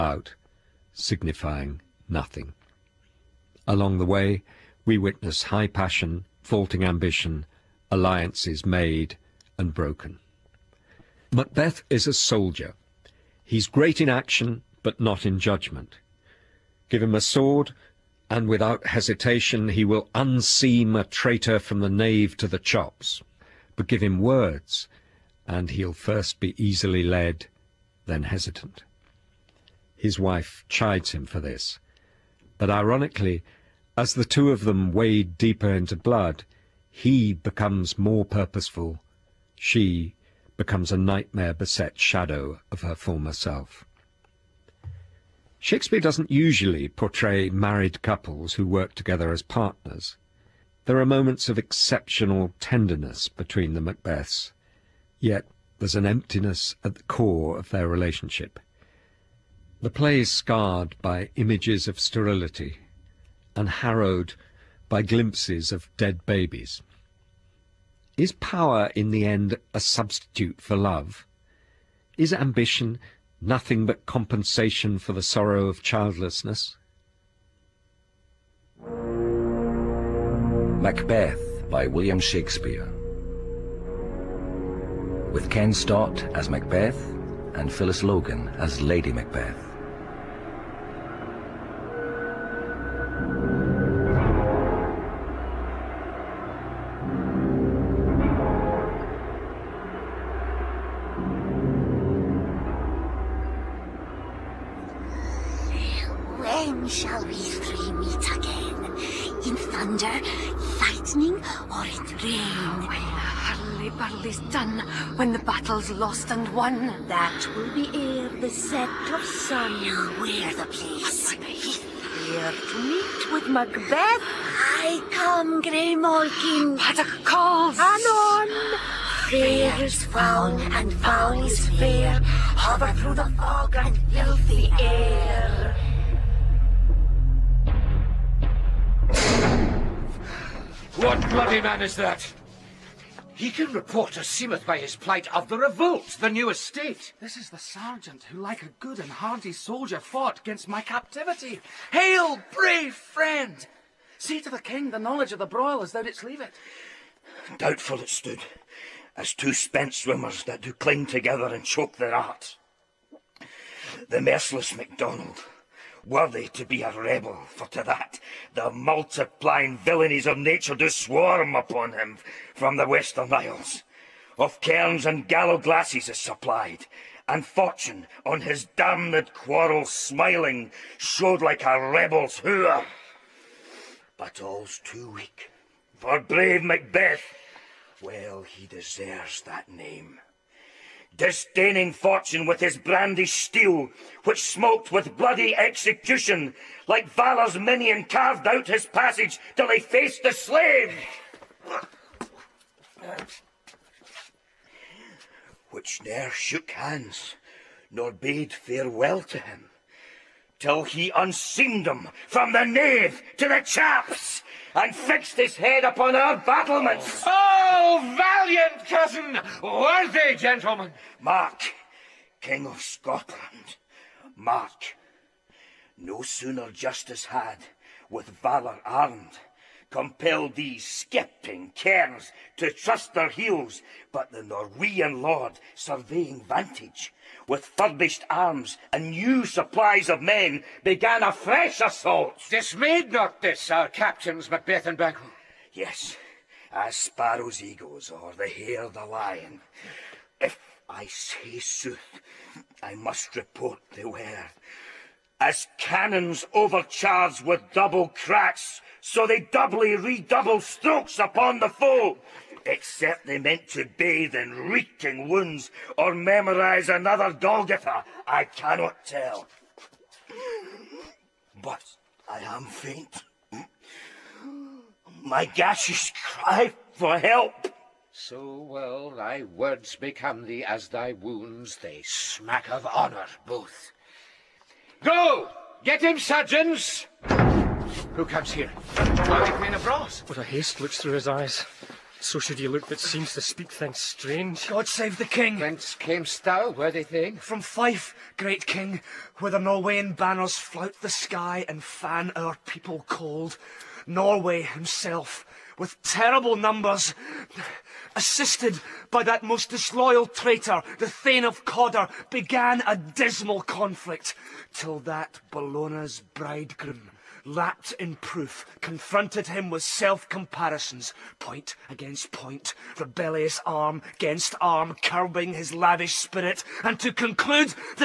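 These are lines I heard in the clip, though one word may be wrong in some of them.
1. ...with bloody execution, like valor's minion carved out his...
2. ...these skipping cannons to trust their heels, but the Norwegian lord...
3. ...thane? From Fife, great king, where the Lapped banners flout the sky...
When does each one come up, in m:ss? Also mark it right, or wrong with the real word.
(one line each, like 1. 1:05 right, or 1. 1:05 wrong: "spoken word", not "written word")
1. 3:14 right
2. 3:50 wrong: "kerns", not "cannons"
3. 4:57 wrong: "Norwegian", not "Lapped".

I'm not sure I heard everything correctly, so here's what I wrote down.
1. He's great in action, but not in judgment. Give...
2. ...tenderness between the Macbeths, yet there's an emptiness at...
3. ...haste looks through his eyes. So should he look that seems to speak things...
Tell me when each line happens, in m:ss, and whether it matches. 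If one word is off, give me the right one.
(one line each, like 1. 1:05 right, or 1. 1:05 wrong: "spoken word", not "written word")
1. 0:13 right
2. 0:52 right
3. 4:50 right.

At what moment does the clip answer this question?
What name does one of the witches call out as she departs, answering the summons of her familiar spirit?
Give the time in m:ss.
2:05.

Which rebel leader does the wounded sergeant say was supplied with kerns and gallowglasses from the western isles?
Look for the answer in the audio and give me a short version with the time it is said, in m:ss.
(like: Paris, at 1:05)
MacDonald, at 2:44.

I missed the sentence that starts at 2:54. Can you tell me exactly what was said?
Of kerns and gallowglasses is supplied, and fortune on his damned quarrel smiling showed like a rebel's hooer.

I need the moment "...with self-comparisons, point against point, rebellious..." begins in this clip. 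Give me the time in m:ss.
5:19.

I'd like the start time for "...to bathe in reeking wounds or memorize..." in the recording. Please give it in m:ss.
4:23.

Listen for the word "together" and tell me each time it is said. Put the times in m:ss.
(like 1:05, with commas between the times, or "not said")
0:48, 2:41.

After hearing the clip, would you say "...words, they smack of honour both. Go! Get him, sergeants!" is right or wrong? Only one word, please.
wrong.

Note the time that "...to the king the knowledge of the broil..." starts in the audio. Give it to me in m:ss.
2:34.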